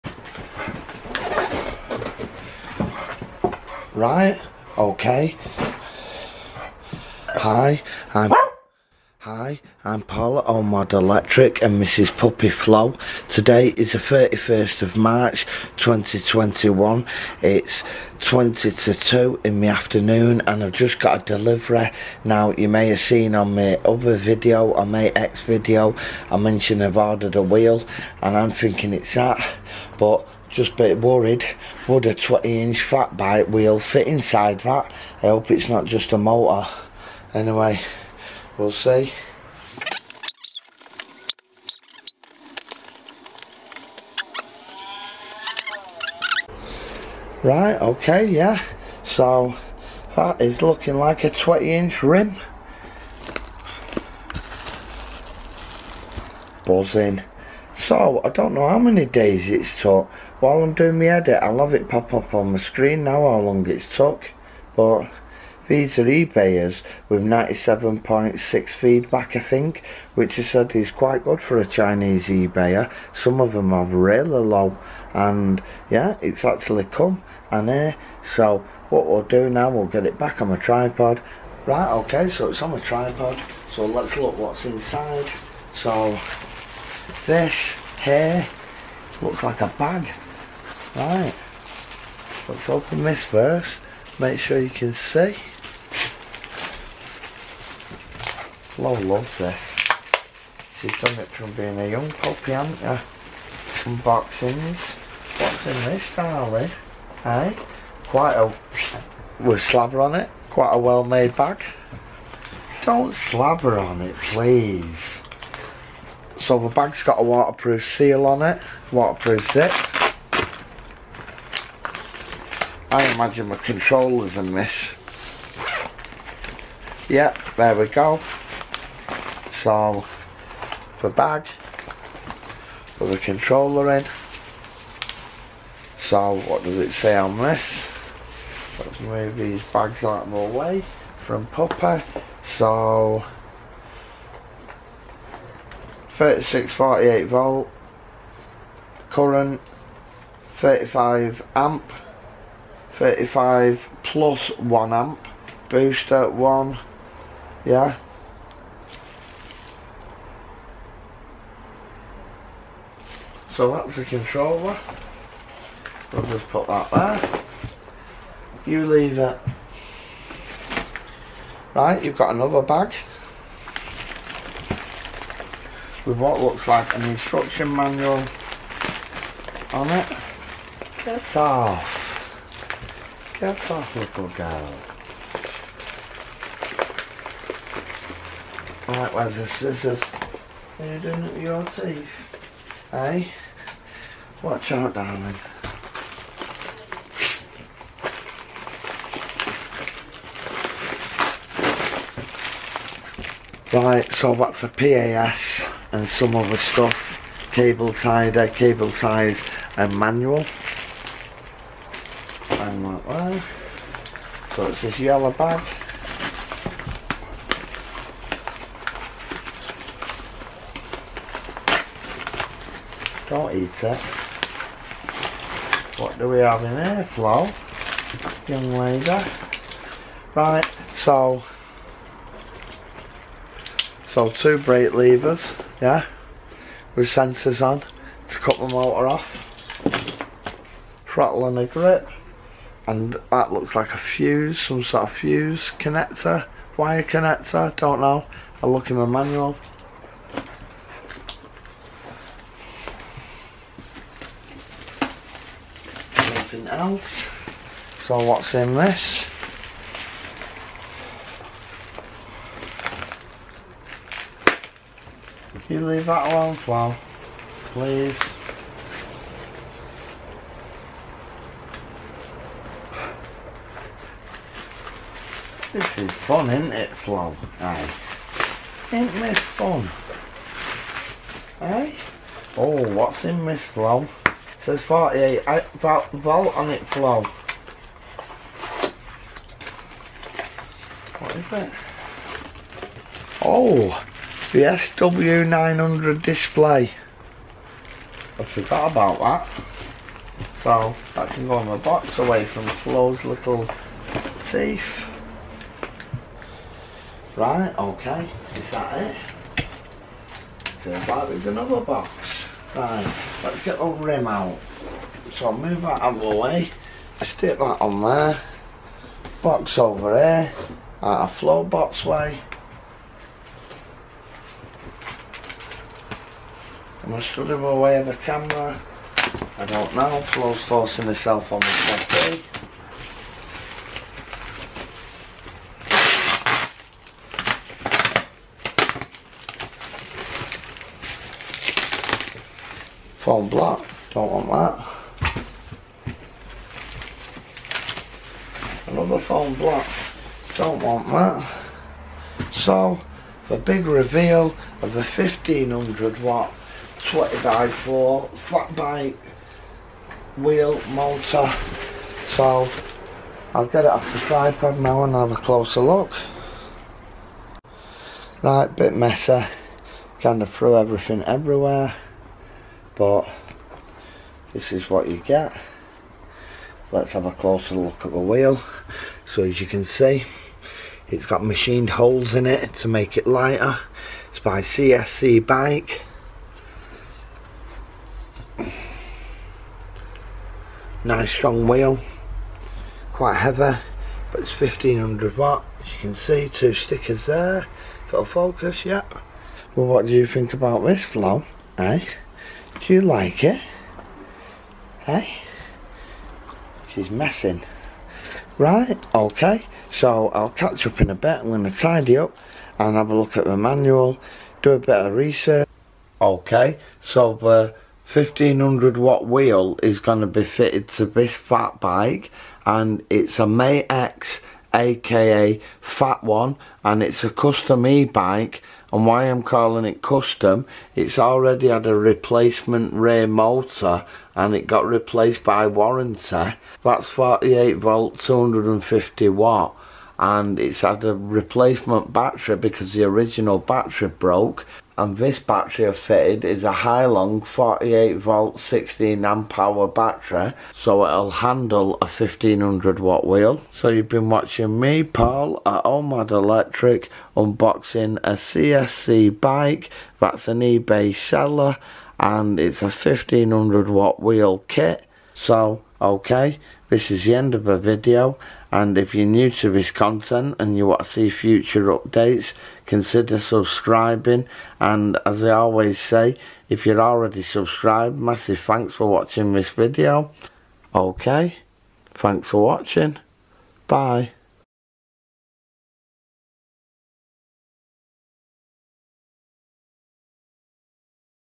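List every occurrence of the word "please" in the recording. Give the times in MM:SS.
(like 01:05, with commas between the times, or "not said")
01:54, 04:27.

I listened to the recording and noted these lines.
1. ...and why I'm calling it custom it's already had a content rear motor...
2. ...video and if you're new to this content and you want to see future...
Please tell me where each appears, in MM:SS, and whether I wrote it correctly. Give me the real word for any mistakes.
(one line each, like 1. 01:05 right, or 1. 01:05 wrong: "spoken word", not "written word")
1. 07:08 wrong: "replacement", not "content"
2. 07:47 right.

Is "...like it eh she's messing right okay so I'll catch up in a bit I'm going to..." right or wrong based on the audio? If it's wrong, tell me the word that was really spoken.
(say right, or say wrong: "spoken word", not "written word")
right.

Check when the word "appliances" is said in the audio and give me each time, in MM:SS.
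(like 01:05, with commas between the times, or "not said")
not said.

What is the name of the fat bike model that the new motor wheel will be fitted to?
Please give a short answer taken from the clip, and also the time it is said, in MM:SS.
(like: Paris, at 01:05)
Mate X, at 07:03.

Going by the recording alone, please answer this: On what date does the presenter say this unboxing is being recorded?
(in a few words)
31 March 2021.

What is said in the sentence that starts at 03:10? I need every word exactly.
Are you doing it with your teeth?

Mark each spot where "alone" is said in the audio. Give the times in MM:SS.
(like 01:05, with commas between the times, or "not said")
04:26.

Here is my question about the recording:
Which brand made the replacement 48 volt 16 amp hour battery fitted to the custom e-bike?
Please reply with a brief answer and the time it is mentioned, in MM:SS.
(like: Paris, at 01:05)
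Hailong, at 07:26.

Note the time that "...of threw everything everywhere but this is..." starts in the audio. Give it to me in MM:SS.
06:10.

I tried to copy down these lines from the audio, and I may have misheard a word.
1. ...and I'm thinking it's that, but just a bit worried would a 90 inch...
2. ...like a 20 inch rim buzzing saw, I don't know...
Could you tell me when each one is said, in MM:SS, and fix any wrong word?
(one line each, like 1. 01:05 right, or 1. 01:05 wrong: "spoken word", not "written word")
1. 00:28 wrong: "20", not "90"
2. 00:50 right.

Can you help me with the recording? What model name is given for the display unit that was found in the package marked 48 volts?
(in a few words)
SW900.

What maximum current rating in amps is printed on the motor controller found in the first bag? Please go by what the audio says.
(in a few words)
35 amp.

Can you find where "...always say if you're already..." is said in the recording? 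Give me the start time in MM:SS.
07:55.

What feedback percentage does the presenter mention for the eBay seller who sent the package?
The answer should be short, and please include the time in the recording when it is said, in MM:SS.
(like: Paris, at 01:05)
97.6, at 01:07.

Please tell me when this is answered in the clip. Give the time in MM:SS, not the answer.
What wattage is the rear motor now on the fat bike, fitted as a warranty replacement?
07:18.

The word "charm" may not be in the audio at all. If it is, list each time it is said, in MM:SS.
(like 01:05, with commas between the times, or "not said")
not said.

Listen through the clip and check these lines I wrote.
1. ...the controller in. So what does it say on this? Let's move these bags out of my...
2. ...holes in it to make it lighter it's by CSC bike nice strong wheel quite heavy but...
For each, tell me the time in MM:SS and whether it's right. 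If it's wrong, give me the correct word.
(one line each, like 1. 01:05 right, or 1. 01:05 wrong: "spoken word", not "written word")
1. 02:13 right
2. 06:21 right.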